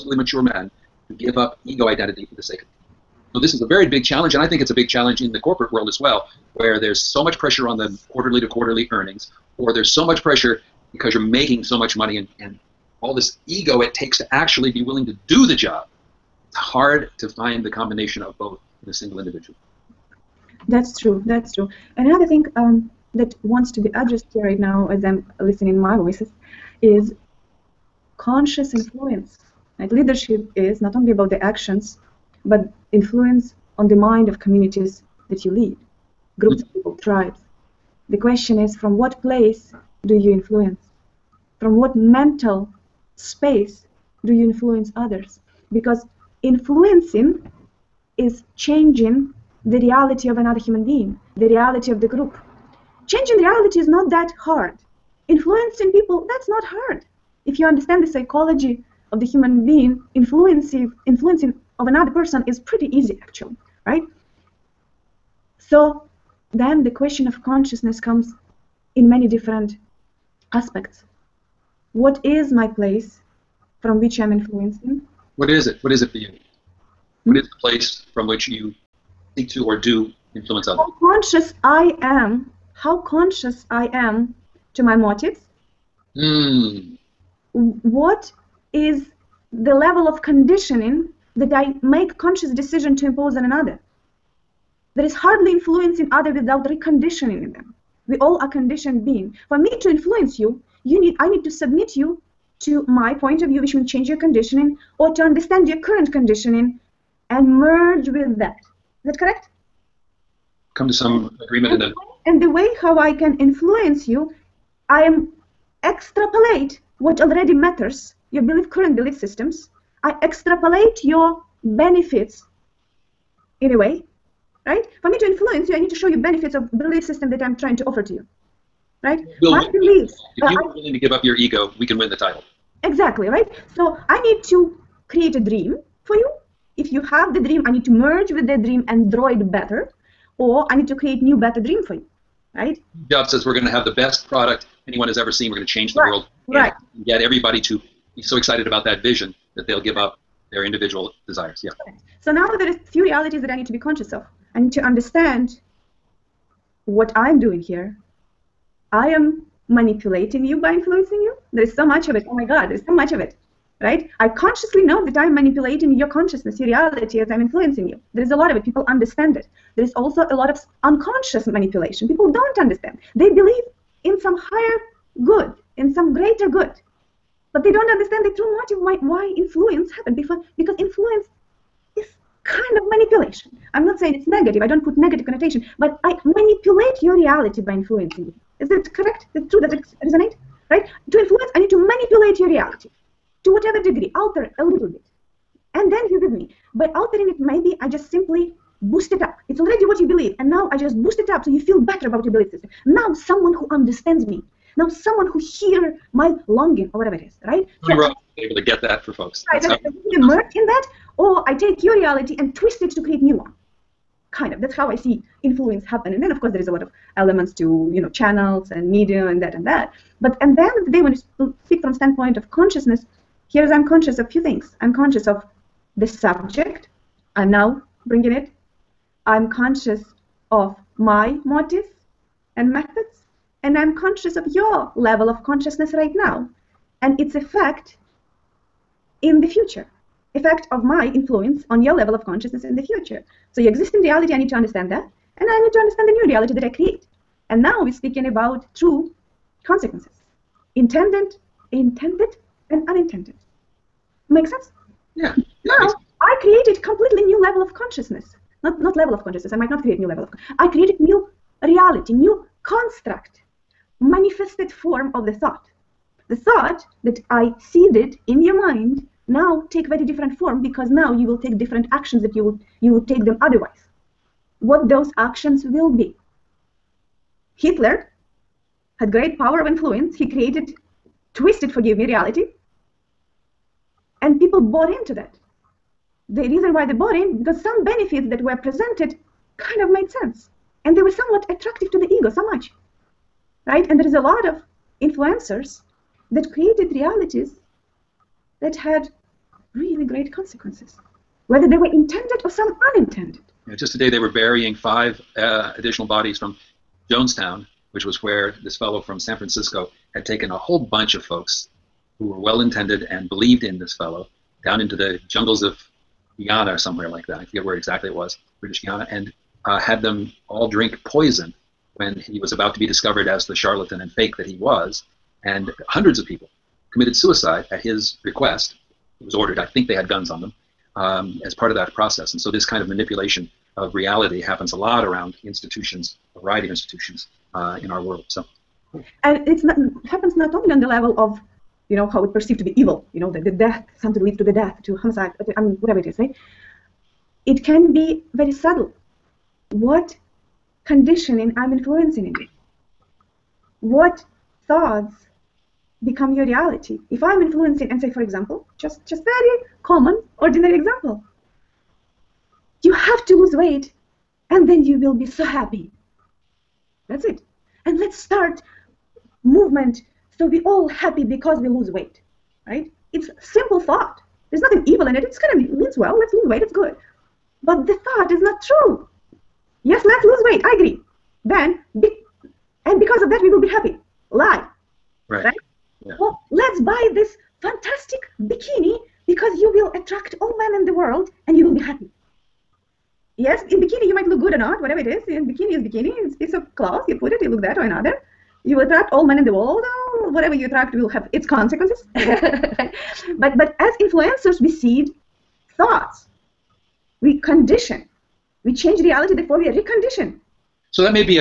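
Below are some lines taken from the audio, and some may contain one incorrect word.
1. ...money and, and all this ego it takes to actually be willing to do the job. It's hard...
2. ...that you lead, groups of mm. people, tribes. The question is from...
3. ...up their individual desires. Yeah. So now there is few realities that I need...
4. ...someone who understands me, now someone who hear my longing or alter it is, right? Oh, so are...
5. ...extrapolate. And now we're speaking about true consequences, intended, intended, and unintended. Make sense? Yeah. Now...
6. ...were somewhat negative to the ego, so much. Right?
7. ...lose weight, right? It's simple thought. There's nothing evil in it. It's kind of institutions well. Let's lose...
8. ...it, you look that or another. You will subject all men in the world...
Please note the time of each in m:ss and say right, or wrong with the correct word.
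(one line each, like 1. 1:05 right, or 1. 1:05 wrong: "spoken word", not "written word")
1. 0:11 right
2. 0:35 right
3. 2:29 right
4. 3:23 wrong: "whatever", not "alter"
5. 4:06 wrong: "create", not "extrapolate"
6. 4:51 wrong: "attractive", not "negative"
7. 6:11 wrong: "means", not "institutions"
8. 6:37 wrong: "attract", not "subject".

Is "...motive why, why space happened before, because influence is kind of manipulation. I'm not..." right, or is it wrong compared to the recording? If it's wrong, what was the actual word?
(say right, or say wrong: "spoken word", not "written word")
wrong: "influence", not "space".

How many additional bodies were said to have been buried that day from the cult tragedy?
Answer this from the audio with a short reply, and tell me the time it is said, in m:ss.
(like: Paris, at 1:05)
5, at 5:04.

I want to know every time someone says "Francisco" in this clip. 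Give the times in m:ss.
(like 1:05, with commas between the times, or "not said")
5:09.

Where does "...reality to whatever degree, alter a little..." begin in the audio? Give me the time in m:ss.
3:12.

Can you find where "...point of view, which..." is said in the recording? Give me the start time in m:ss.
1:43.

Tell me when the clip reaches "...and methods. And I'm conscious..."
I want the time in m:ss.
3:52.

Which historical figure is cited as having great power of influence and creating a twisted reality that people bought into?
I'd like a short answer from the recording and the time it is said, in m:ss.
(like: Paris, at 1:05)
Hitler, at 4:37.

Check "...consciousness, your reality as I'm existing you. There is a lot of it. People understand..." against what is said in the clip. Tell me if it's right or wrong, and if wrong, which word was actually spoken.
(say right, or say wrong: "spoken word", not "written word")
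wrong: "influencing", not "existing".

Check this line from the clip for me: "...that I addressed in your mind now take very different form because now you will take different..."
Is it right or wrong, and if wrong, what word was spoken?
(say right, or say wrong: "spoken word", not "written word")
wrong: "seeded", not "addressed".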